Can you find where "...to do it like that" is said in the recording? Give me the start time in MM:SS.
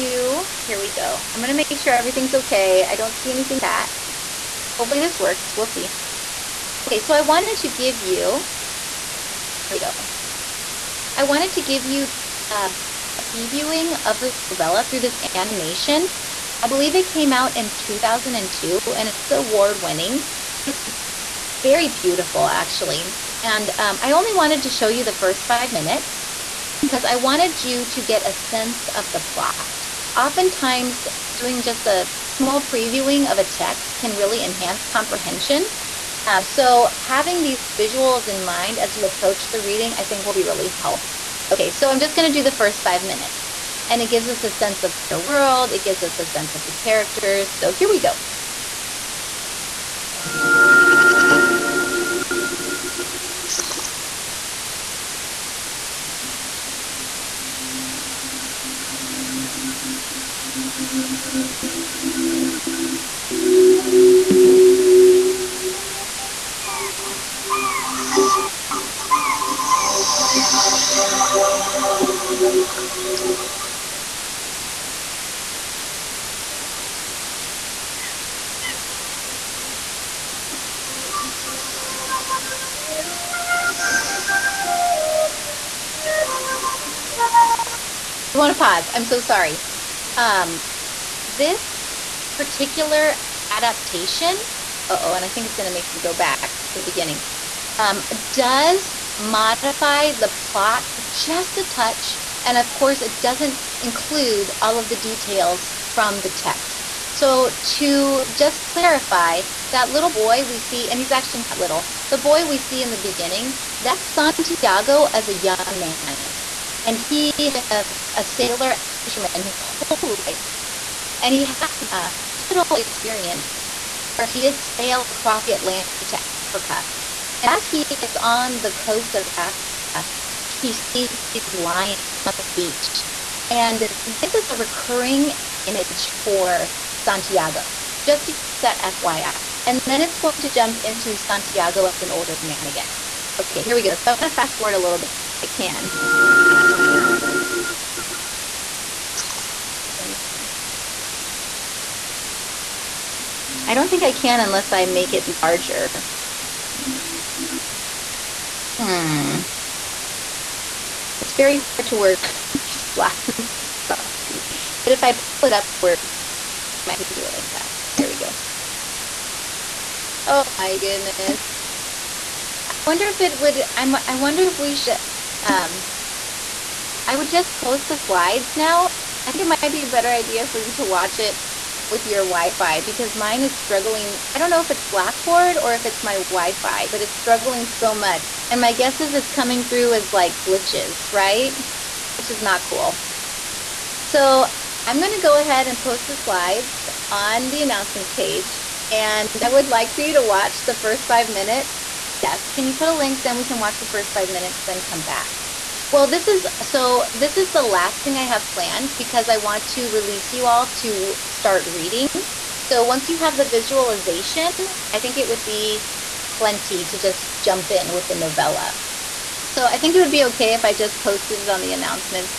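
02:47.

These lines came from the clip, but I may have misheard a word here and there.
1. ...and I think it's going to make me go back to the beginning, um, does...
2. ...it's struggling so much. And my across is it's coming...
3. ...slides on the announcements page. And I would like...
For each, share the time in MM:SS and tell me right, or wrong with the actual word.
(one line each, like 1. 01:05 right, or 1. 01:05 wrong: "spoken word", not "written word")
1. 01:35 right
2. 03:07 wrong: "guess", not "across"
3. 03:16 right.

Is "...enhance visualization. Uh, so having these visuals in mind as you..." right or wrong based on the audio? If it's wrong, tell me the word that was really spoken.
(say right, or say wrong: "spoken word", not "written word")
wrong: "comprehension", not "visualization".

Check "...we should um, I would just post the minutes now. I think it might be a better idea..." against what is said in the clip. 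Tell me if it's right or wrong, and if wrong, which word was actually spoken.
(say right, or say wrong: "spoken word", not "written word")
wrong: "slides", not "minutes".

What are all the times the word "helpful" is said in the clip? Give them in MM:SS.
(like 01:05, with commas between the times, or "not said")
00:40.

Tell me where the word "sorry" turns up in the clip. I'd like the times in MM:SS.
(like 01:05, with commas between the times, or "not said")
01:29, 02:42.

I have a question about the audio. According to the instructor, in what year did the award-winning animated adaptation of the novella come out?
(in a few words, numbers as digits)
2002.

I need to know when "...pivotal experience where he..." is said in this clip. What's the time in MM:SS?
02:02.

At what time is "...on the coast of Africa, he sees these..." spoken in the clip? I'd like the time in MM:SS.
02:08.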